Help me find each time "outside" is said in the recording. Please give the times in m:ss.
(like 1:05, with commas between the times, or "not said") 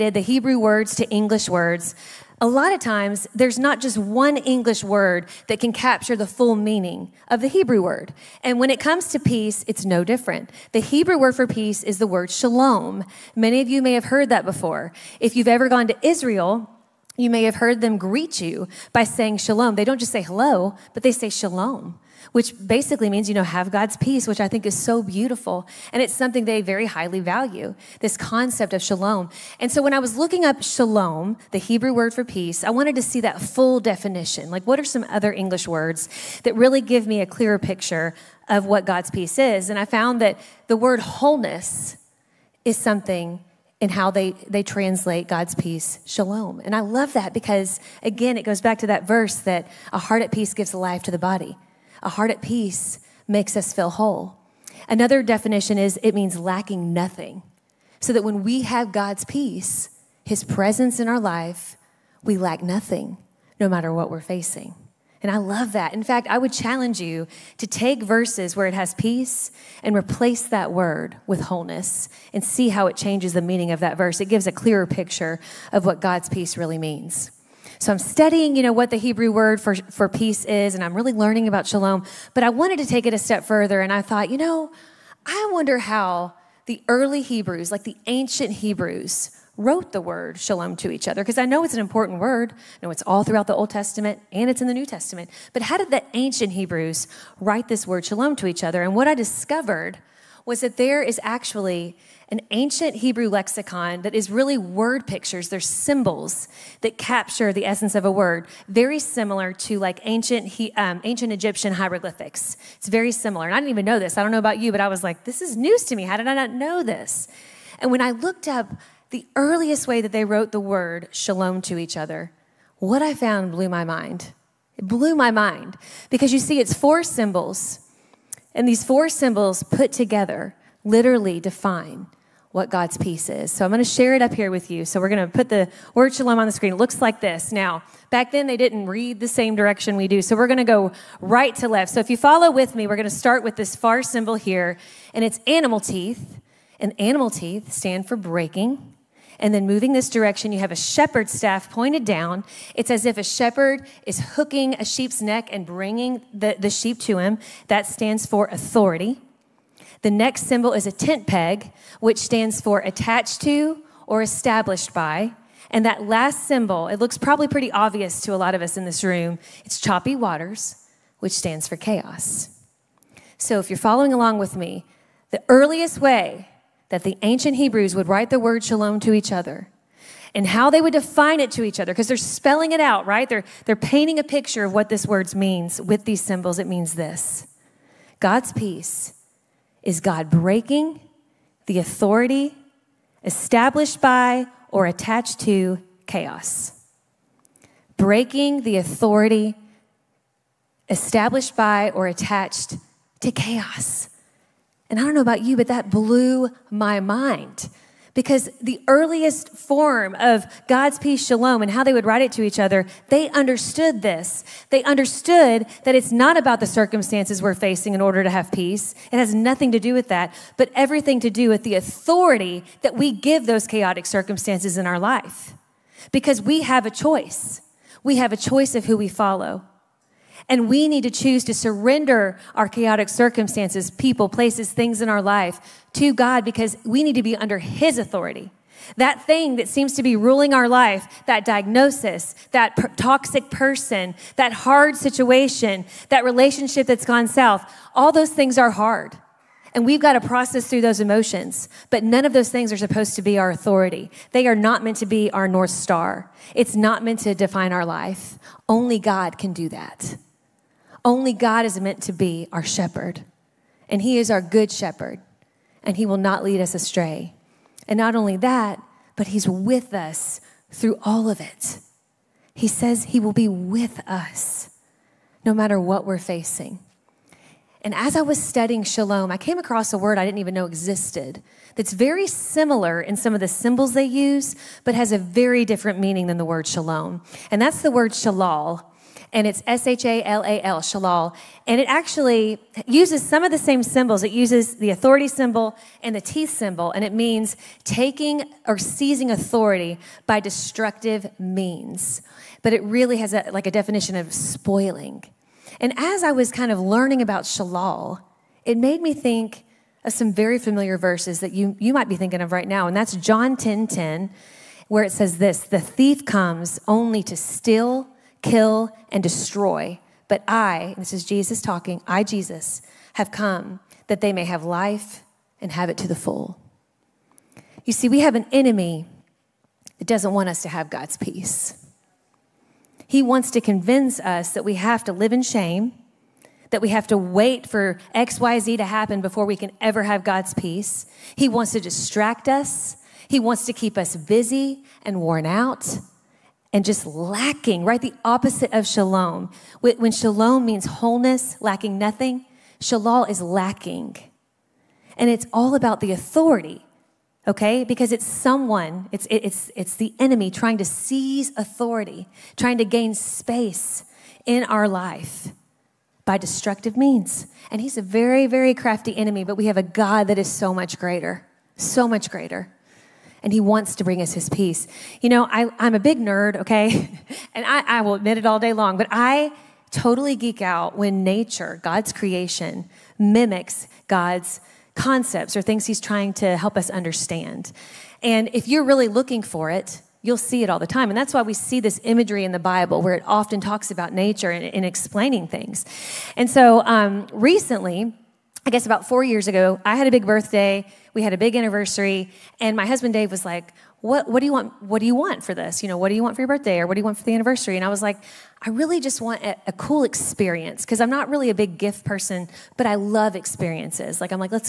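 not said.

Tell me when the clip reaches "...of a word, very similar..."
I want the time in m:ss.
1:47.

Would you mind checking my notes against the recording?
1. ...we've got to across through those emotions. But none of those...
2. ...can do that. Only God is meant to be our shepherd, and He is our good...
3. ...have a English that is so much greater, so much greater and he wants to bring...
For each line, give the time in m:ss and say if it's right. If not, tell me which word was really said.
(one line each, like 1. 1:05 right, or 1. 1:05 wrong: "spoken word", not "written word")
1. 4:09 wrong: "process", not "across"
2. 4:19 right
3. 6:09 wrong: "God", not "English".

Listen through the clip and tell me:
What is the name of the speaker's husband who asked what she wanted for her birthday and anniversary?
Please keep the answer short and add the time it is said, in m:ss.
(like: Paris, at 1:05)
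Dave, at 6:43.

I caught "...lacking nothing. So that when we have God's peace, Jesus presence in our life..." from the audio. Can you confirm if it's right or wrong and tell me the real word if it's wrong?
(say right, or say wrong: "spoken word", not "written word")
wrong: "His", not "Jesus".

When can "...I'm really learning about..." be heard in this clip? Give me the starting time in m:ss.
1:20.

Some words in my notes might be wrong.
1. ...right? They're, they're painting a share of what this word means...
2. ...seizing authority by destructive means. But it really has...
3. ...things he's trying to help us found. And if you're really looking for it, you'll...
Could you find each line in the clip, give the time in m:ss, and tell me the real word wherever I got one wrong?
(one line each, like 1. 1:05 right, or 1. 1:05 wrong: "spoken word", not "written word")
1. 3:03 wrong: "picture", not "share"
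2. 4:58 right
3. 6:25 wrong: "understand", not "found".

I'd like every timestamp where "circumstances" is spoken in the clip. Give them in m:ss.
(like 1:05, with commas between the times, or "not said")
3:36, 3:44, 3:53.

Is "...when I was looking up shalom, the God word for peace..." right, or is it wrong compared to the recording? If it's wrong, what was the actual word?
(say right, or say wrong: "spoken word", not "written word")
wrong: "Hebrew", not "God".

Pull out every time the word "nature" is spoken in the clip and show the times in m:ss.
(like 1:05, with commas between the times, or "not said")
6:21, 6:34.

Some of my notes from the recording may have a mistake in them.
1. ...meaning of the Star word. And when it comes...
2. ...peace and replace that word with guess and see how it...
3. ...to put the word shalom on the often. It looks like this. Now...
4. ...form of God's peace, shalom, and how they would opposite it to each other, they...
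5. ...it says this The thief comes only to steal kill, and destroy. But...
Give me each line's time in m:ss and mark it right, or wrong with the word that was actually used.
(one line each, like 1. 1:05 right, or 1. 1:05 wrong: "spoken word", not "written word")
1. 0:06 wrong: "Hebrew", not "Star"
2. 1:08 wrong: "wholeness", not "guess"
3. 2:15 wrong: "screen", not "often"
4. 3:29 wrong: "write", not "opposite"
5. 5:15 right.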